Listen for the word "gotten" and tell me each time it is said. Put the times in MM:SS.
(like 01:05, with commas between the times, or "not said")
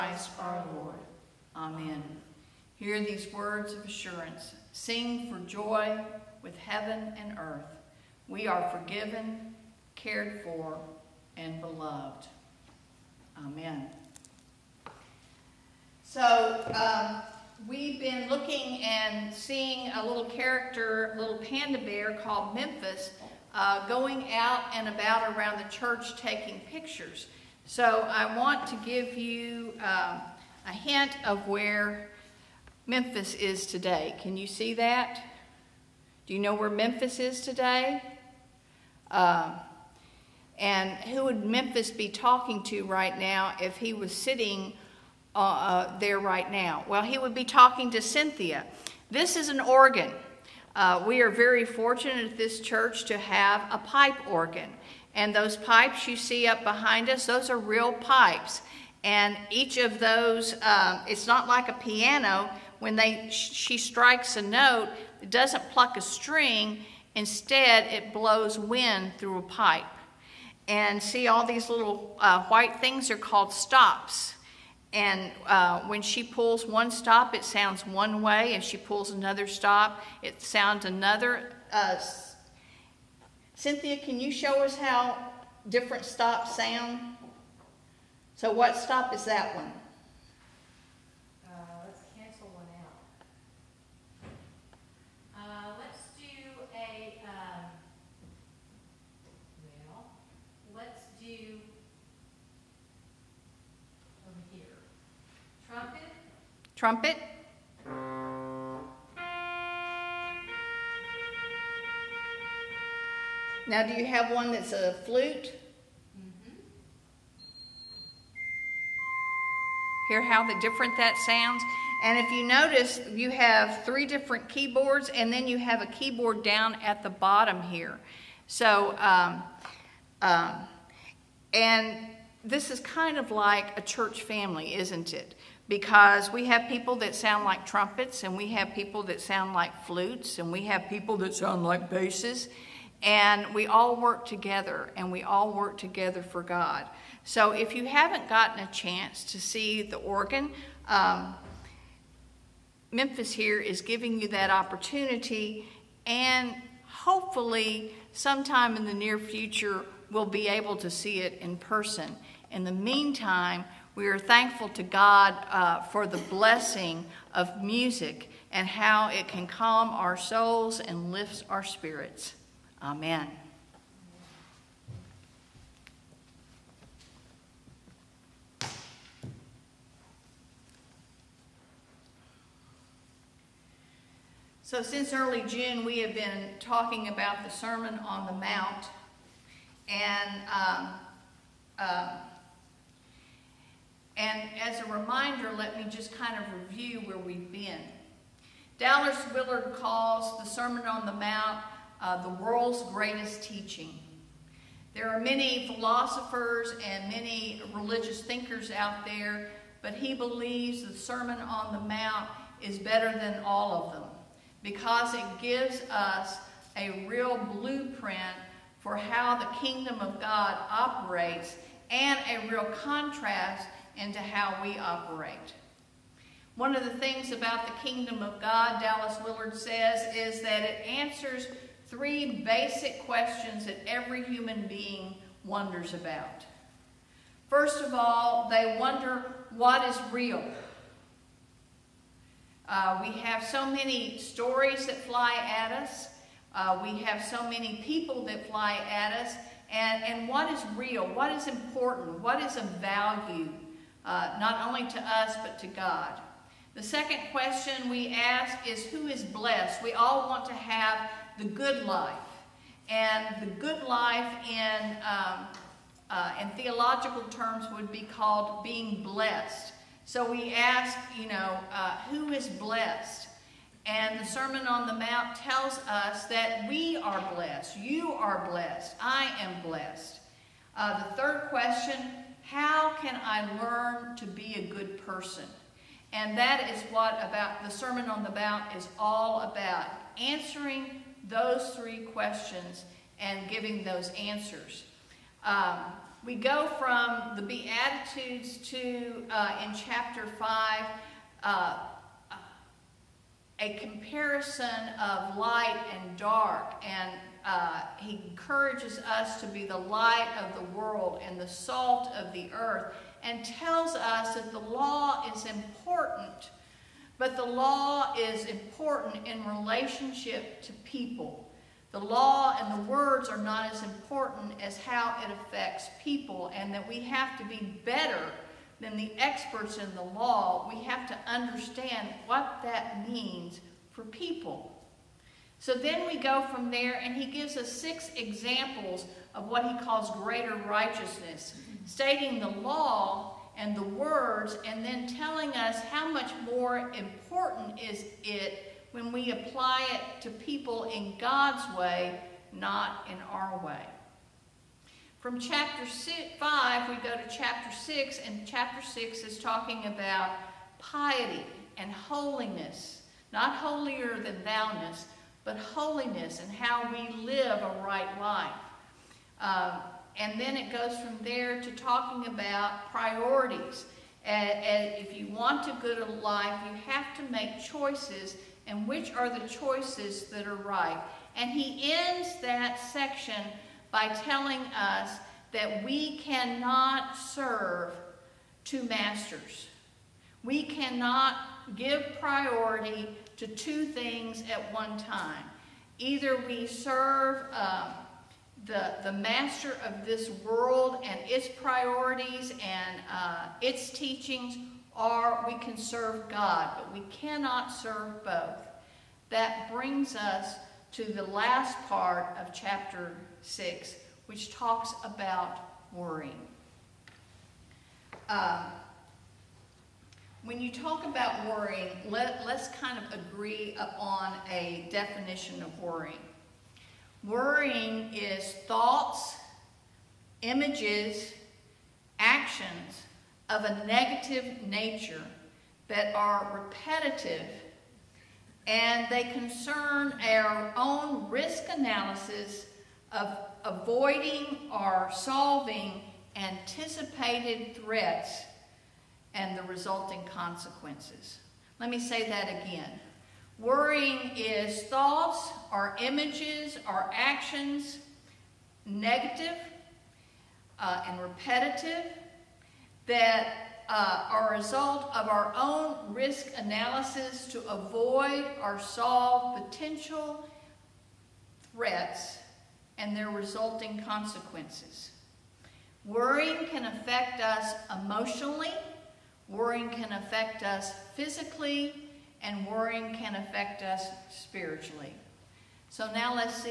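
02:28.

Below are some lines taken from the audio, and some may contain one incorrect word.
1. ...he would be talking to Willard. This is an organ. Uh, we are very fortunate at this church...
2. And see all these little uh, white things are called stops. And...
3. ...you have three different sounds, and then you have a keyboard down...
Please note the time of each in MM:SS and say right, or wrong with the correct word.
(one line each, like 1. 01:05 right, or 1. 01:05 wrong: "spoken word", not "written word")
1. 00:47 wrong: "Cynthia", not "Willard"
2. 01:10 right
3. 02:03 wrong: "keyboards", not "sounds".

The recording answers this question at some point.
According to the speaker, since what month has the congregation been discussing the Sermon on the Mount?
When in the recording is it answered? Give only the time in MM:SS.
03:05.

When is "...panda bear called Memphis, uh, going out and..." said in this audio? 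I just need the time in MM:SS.
00:21.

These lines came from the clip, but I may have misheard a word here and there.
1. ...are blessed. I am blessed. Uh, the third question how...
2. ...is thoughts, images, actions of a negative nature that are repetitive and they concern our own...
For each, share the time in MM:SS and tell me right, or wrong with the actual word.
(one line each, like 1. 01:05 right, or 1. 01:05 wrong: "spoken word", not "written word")
1. 04:38 right
2. 07:08 right.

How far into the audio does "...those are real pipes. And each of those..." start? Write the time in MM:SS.
00:57.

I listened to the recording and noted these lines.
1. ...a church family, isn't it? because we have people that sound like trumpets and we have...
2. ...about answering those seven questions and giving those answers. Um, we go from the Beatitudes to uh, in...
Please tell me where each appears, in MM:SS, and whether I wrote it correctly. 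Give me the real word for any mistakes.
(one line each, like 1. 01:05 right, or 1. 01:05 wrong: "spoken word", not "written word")
1. 02:13 right
2. 04:49 wrong: "three", not "seven".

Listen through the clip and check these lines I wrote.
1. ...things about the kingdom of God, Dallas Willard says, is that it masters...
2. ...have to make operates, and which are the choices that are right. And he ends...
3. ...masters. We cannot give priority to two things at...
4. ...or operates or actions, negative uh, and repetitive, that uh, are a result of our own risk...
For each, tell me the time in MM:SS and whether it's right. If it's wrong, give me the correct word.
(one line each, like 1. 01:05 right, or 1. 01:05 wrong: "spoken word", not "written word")
1. 03:46 wrong: "answers", not "masters"
2. 06:16 wrong: "choices", not "operates"
3. 06:28 right
4. 07:35 wrong: "images", not "operates".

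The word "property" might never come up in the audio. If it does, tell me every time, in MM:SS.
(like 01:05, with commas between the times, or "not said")
not said.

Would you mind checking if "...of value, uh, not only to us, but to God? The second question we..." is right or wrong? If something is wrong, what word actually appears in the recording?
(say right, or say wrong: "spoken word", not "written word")
right.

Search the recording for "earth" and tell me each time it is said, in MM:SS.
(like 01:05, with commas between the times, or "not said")
00:07, 05:12.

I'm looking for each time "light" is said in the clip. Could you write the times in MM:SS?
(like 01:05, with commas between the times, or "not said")
05:05, 05:09.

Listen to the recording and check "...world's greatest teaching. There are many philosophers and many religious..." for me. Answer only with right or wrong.
right.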